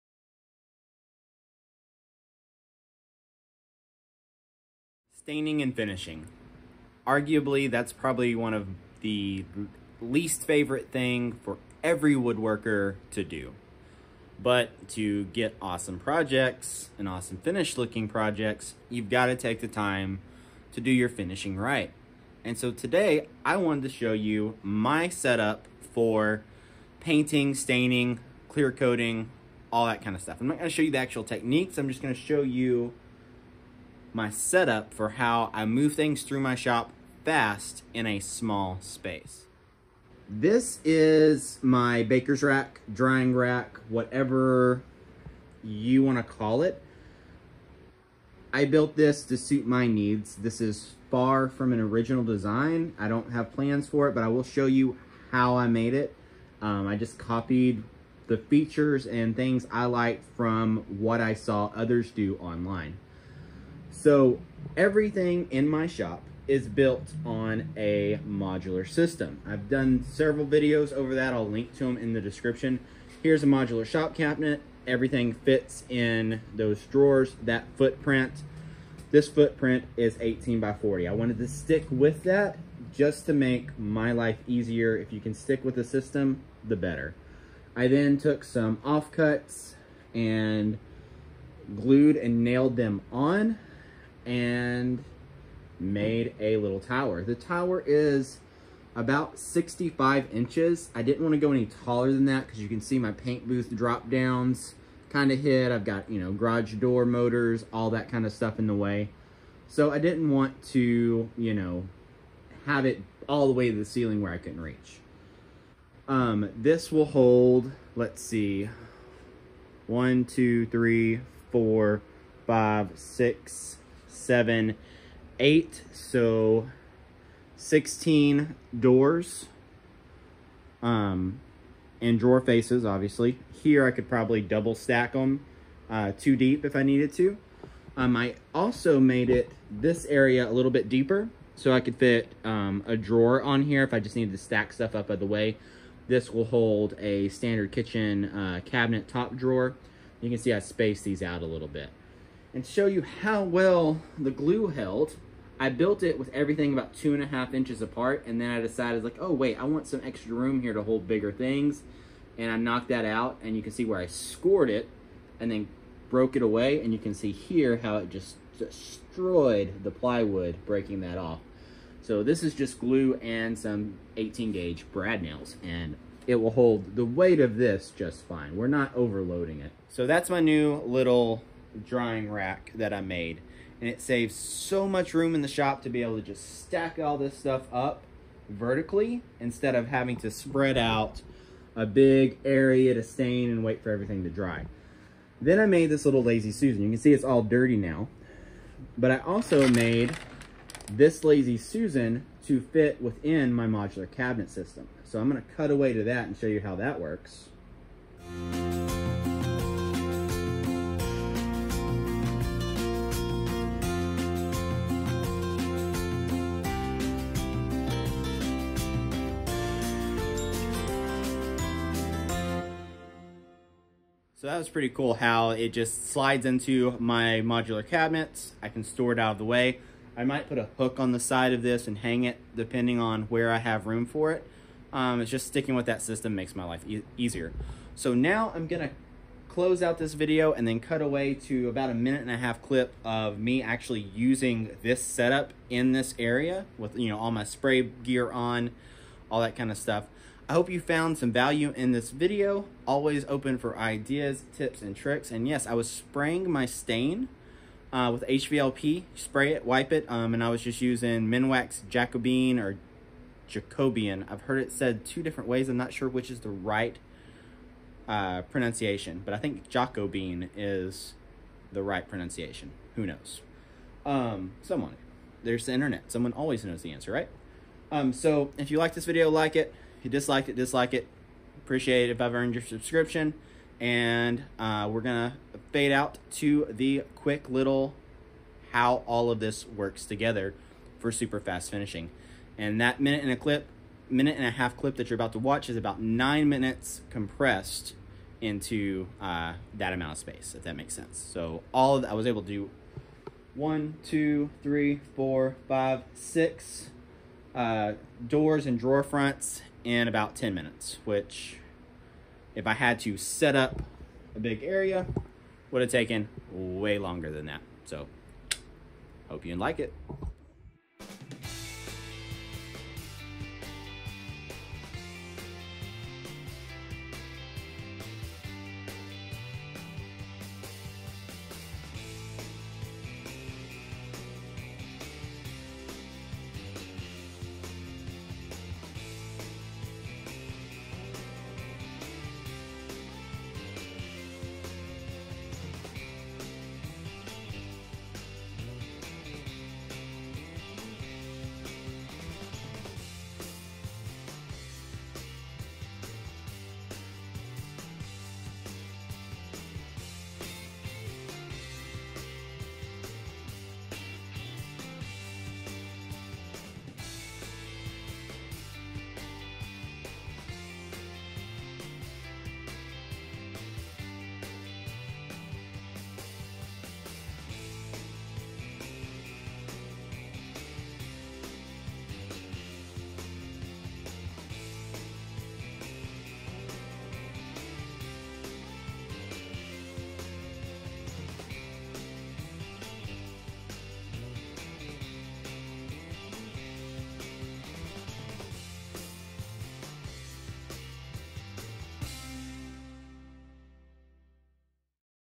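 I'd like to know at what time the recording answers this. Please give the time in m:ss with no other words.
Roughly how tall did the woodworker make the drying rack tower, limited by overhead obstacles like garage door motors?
1:39.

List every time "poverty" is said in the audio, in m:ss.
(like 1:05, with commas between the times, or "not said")
not said.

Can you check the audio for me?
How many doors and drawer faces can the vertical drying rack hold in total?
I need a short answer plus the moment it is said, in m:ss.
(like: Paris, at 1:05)
16, at 2:07.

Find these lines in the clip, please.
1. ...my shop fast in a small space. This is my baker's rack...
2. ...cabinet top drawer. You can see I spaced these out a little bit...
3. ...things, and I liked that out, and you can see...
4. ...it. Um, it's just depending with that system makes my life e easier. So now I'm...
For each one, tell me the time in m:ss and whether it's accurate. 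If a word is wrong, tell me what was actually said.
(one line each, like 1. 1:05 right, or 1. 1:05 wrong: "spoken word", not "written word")
1. 0:36 right
2. 2:28 right
3. 2:41 wrong: "knocked", not "liked"
4. 3:54 wrong: "sticking", not "depending".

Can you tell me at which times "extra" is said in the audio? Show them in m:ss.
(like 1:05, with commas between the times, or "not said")
2:40.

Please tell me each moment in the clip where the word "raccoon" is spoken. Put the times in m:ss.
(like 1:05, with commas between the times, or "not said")
not said.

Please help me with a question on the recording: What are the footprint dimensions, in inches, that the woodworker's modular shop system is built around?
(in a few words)
18 by 40.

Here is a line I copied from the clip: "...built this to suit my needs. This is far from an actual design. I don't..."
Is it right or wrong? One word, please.
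wrong.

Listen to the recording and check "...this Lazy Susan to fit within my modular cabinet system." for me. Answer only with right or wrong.
right.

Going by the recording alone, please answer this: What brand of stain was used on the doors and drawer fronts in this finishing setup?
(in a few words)
Minwax.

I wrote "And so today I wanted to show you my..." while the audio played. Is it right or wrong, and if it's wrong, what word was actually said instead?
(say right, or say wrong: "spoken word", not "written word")
right.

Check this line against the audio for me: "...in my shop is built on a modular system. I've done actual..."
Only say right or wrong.
wrong.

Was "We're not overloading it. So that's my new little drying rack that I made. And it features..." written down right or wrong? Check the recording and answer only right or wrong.
wrong.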